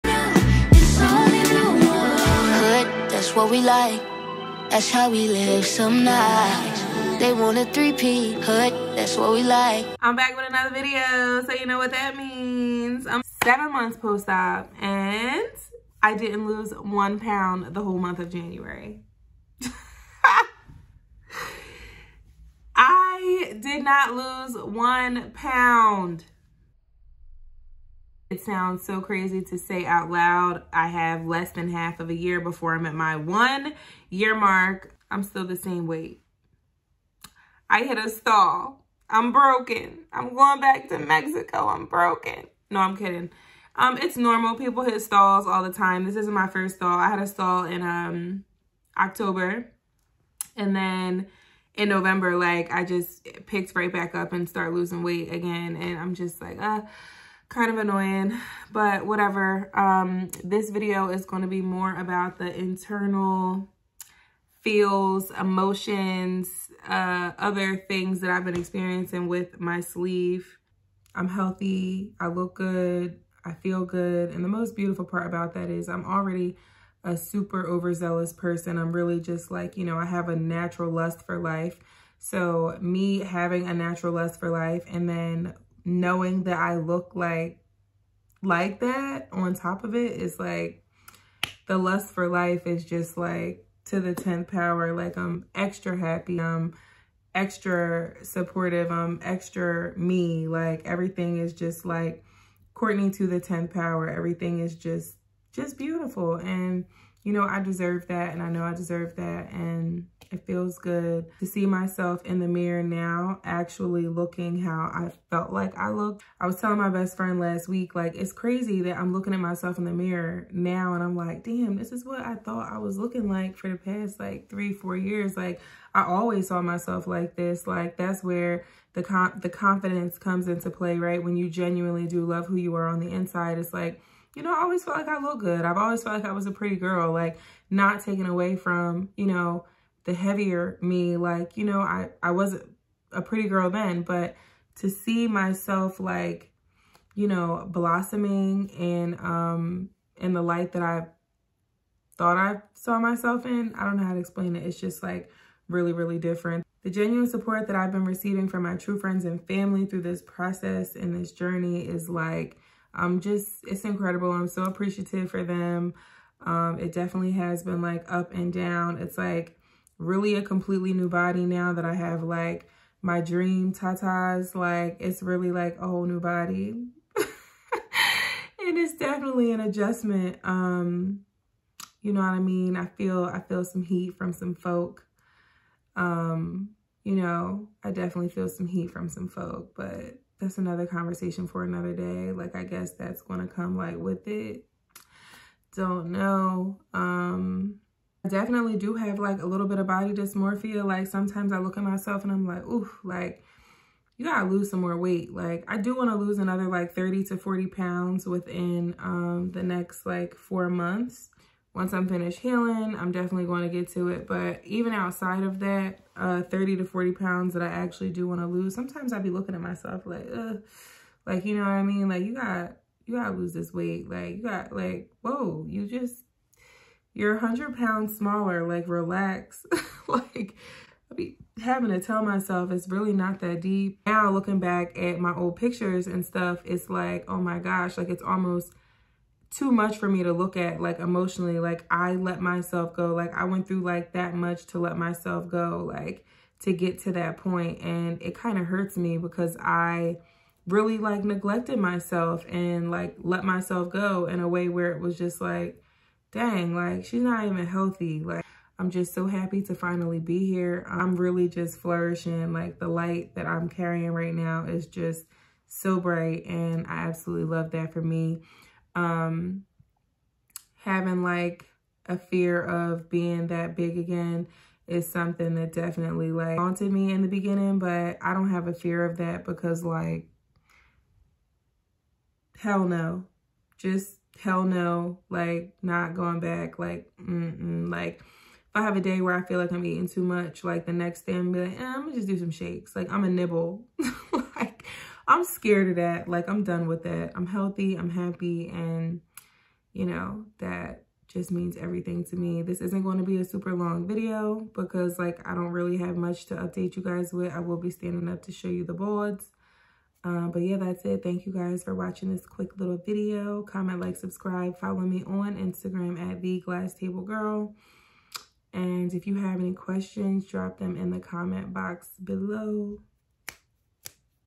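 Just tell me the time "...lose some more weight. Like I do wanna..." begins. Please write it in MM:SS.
03:24.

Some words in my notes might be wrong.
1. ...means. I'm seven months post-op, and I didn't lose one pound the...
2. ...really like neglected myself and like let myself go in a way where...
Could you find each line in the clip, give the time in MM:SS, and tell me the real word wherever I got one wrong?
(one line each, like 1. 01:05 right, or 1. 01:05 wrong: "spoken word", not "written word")
1. 00:12 right
2. 04:10 right.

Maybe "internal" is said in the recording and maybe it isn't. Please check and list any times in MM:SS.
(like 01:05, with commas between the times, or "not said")
01:02.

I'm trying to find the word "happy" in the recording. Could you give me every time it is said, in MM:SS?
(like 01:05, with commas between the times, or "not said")
01:35, 04:19, 04:58.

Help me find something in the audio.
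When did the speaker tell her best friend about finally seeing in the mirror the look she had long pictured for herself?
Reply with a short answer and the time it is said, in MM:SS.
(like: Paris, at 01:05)
last week, at 01:57.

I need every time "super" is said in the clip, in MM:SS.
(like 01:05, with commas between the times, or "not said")
01:17, 05:03.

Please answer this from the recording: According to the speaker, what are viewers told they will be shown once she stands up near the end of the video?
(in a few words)
the boards.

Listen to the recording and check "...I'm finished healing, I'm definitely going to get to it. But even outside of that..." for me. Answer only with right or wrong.
right.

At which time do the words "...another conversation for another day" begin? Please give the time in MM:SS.
03:10.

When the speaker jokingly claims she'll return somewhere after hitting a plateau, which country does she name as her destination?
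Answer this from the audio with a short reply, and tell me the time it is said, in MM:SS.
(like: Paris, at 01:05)
Mexico, at 00:40.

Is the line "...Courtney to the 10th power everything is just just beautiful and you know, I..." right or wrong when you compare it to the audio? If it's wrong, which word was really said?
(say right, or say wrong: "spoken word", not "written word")
right.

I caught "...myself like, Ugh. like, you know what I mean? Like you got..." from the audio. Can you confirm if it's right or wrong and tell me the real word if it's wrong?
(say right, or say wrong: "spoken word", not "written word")
right.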